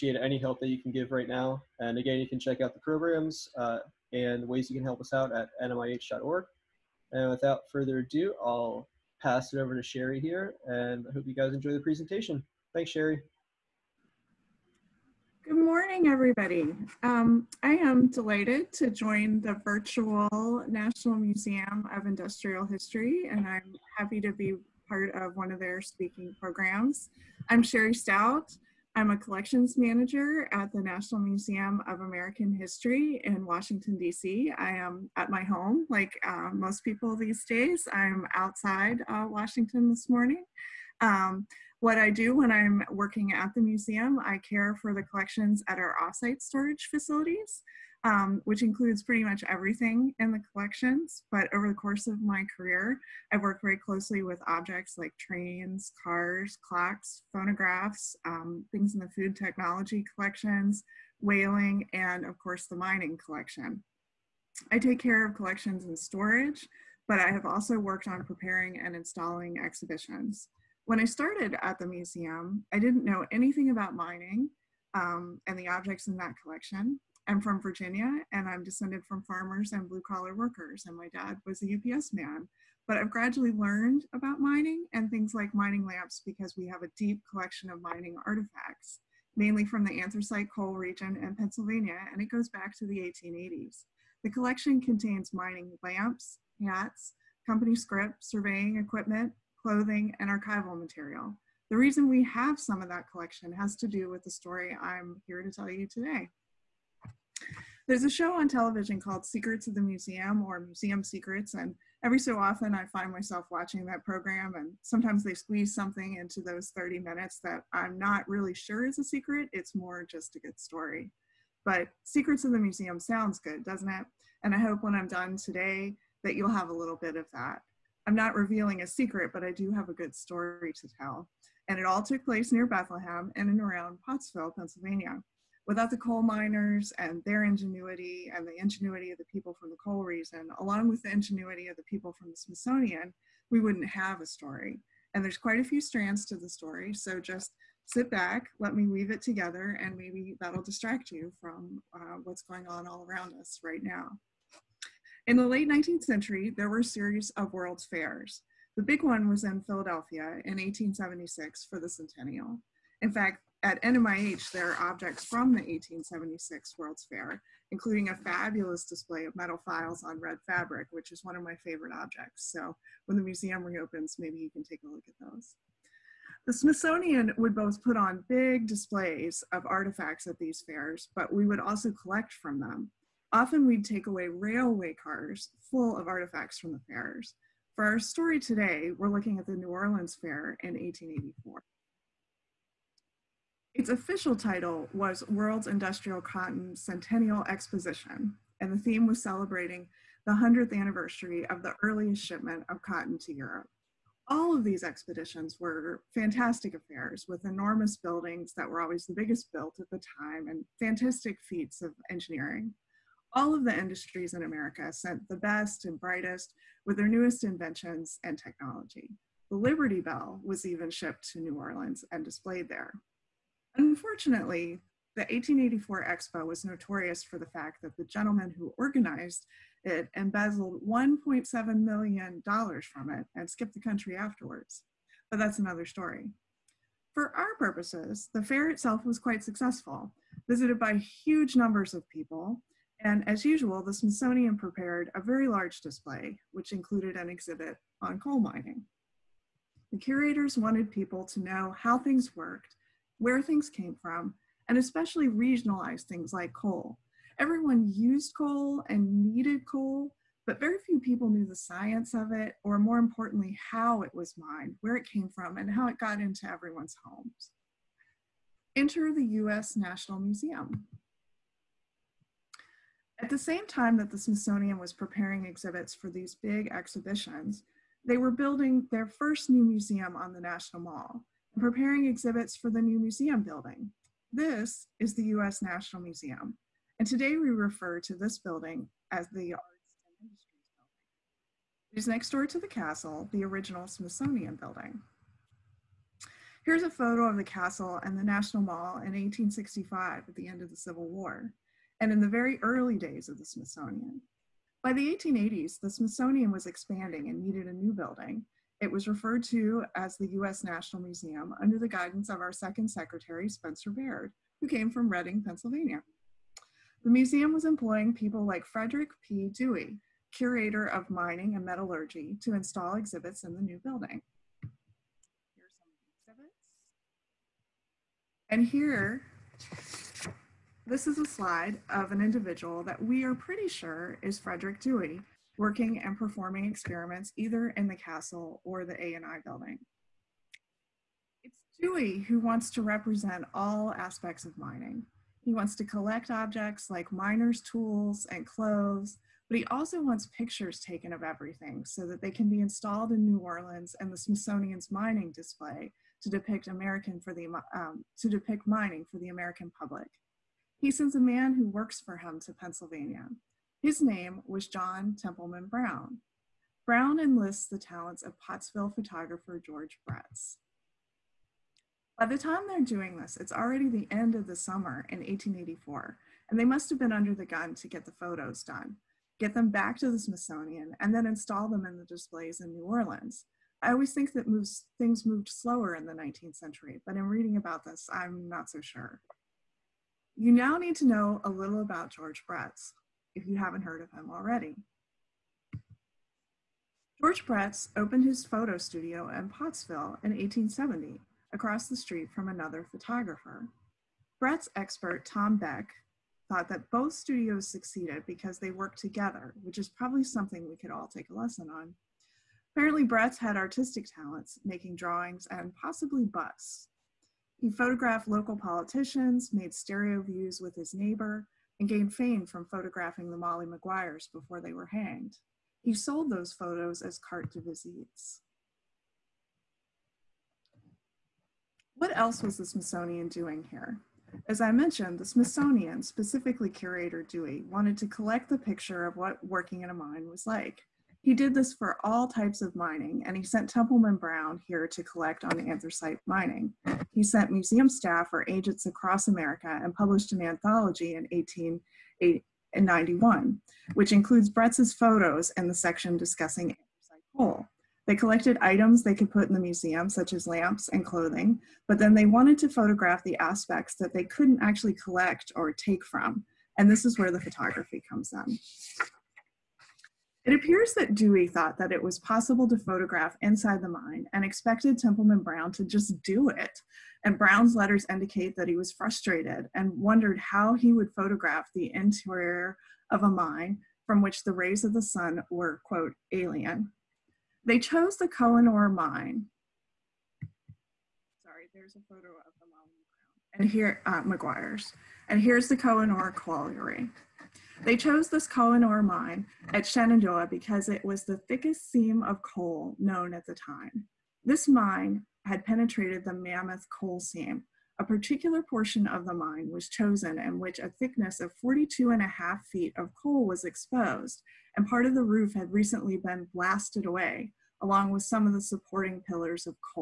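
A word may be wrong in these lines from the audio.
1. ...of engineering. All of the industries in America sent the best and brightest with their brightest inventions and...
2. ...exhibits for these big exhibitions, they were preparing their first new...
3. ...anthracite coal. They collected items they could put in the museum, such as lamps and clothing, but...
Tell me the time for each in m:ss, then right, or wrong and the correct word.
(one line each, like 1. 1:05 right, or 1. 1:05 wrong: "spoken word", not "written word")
1. 3:31 wrong: "newest", not "brightest"
2. 4:35 wrong: "building", not "preparing"
3. 7:36 right.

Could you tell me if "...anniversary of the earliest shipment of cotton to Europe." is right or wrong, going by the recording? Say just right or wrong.
right.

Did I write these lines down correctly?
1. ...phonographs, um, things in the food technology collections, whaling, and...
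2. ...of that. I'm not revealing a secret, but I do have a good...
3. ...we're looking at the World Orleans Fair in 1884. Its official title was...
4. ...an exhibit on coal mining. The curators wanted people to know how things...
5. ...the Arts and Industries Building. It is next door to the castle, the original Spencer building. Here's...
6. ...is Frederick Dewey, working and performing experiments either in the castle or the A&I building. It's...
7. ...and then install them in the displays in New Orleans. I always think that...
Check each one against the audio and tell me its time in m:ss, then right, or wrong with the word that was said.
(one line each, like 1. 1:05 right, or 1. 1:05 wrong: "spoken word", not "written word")
1. 0:57 right
2. 2:07 right
3. 3:08 wrong: "New", not "World"
4. 4:07 right
5. 4:49 wrong: "Smithsonian", not "Spencer"
6. 5:34 right
7. 6:21 right.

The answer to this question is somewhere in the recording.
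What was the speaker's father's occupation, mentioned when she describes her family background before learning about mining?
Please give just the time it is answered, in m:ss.
1:21.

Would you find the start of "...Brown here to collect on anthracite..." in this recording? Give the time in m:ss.
7:24.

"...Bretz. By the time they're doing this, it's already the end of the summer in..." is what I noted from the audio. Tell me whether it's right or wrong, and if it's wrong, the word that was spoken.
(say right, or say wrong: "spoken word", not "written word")
right.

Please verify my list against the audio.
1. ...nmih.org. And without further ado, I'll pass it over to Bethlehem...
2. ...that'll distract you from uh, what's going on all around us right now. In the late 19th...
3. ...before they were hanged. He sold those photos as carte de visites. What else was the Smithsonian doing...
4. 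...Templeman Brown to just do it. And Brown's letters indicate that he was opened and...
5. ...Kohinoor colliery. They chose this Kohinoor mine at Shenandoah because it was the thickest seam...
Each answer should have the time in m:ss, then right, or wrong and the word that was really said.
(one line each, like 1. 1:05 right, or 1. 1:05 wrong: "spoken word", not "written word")
1. 0:05 wrong: "Shari", not "Bethlehem"
2. 2:30 right
3. 7:04 right
4. 7:54 wrong: "frustrated", not "opened"
5. 8:15 right.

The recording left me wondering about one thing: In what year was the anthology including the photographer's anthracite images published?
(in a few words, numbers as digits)
1891.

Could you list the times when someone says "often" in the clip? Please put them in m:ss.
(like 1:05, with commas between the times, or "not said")
1:52, 3:03.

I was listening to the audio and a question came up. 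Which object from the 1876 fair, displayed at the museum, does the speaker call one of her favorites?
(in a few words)
metal files.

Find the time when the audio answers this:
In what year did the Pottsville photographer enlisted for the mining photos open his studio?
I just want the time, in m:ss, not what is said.
6:40.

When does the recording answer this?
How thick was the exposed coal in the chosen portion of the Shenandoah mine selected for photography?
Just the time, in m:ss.
8:31.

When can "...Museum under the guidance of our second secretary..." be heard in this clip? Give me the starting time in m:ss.
5:11.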